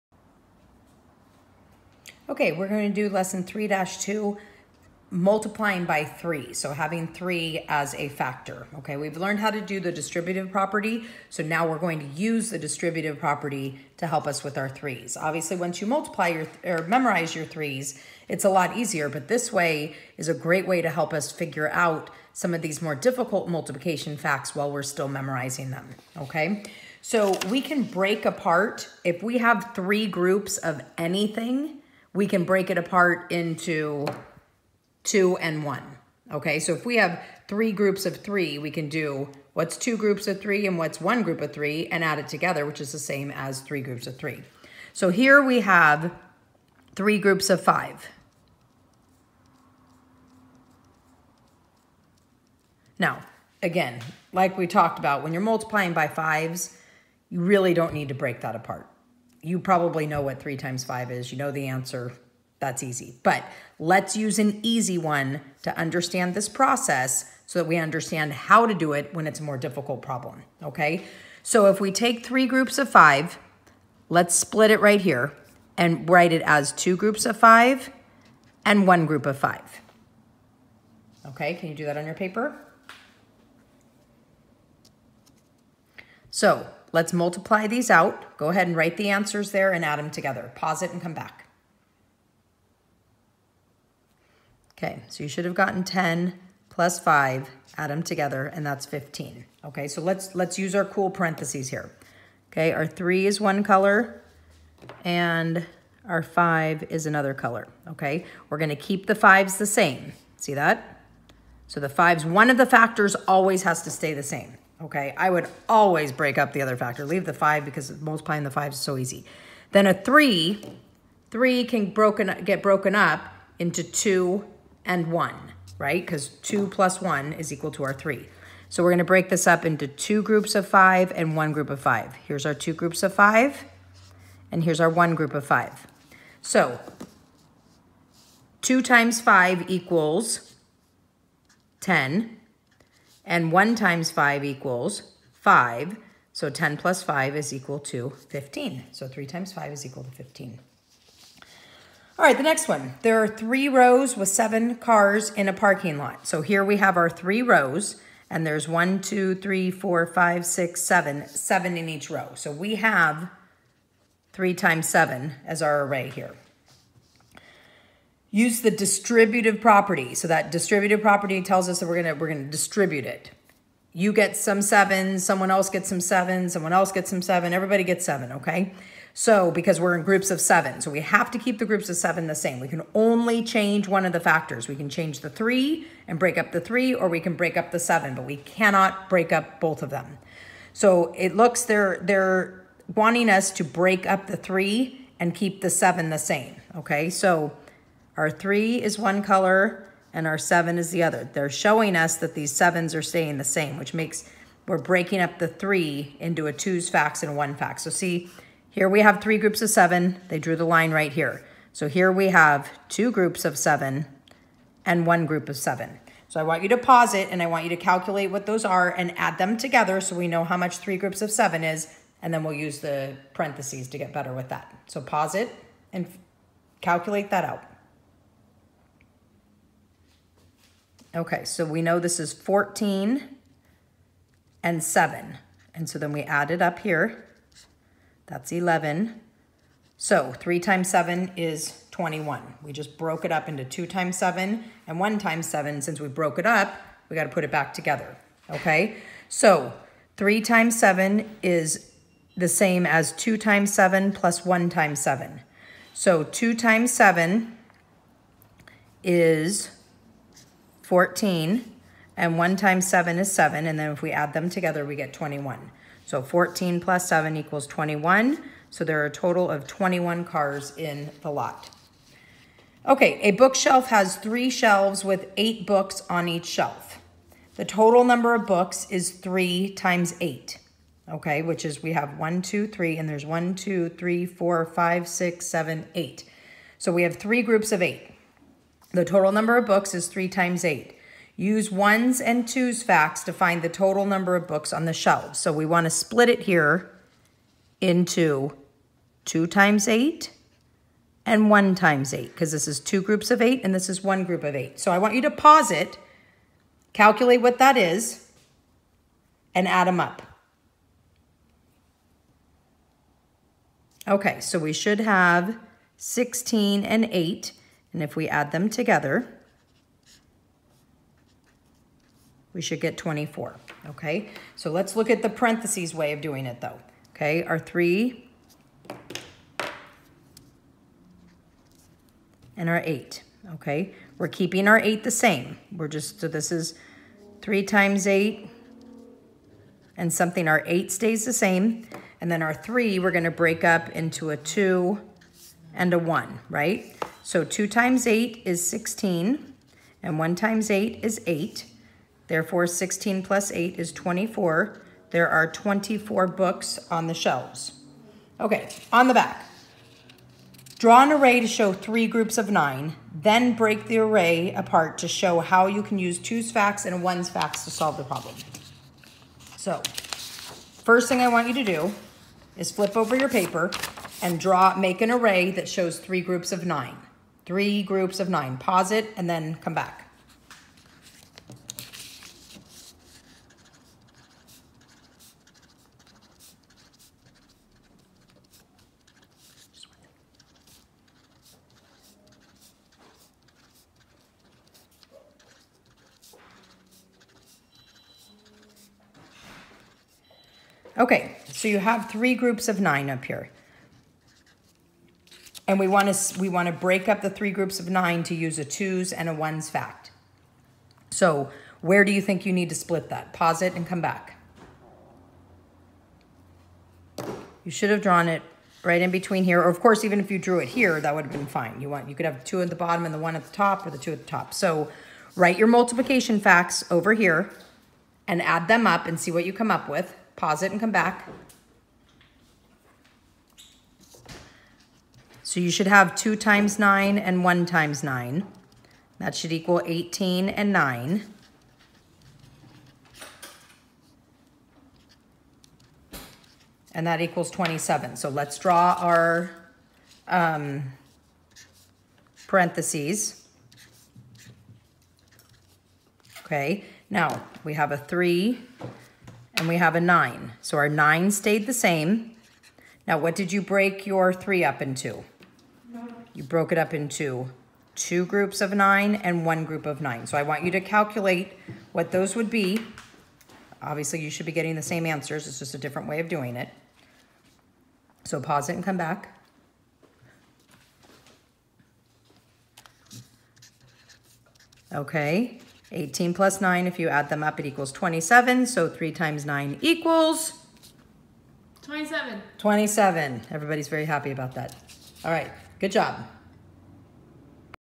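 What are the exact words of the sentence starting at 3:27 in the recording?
So see, here we have three groups of seven.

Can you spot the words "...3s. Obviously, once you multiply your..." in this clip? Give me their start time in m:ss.
0:14.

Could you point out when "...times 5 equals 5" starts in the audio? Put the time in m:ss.
2:23.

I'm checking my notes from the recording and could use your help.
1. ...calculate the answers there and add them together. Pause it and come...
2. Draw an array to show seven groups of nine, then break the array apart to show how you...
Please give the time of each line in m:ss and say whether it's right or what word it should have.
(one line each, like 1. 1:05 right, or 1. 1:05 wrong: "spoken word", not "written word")
1. 1:28 wrong: "write", not "calculate"
2. 6:00 wrong: "three", not "seven".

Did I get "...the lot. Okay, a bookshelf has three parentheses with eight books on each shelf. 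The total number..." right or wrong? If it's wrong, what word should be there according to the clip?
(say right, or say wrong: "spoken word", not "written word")
wrong: "shelves", not "parentheses".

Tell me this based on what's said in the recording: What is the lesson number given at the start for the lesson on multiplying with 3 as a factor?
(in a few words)
3-2.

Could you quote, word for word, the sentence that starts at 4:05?
Since we broke it up, we got to put it back together.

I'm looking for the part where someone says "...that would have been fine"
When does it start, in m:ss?
7:00.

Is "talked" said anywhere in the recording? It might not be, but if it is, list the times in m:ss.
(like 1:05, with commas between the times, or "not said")
0:54.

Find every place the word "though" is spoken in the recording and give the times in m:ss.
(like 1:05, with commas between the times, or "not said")
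5:26.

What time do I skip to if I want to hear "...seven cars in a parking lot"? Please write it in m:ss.
2:34.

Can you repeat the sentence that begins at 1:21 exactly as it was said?
Okay, can you do that on your paper?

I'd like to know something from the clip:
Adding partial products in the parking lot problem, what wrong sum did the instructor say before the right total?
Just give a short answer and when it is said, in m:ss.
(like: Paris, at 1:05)
11, at 3:58.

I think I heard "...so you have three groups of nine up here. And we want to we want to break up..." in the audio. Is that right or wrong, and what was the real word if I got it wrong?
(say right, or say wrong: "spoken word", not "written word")
right.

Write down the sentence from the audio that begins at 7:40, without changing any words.
So our 9 stayed the same.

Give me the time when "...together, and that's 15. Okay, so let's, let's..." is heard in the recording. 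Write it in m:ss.
1:38.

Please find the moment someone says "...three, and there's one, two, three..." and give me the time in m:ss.
4:42.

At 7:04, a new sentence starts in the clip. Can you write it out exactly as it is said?
So write your multiplication facts over here and add them up and see what you come up with.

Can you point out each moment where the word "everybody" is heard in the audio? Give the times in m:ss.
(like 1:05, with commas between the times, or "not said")
2:57, 8:13.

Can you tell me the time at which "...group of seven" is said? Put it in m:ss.
3:35.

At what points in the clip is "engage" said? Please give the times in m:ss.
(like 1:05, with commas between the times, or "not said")
not said.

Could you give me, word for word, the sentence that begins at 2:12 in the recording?
Here's our two groups of five, and here's our one group of five.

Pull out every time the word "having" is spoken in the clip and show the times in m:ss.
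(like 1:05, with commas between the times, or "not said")
0:06.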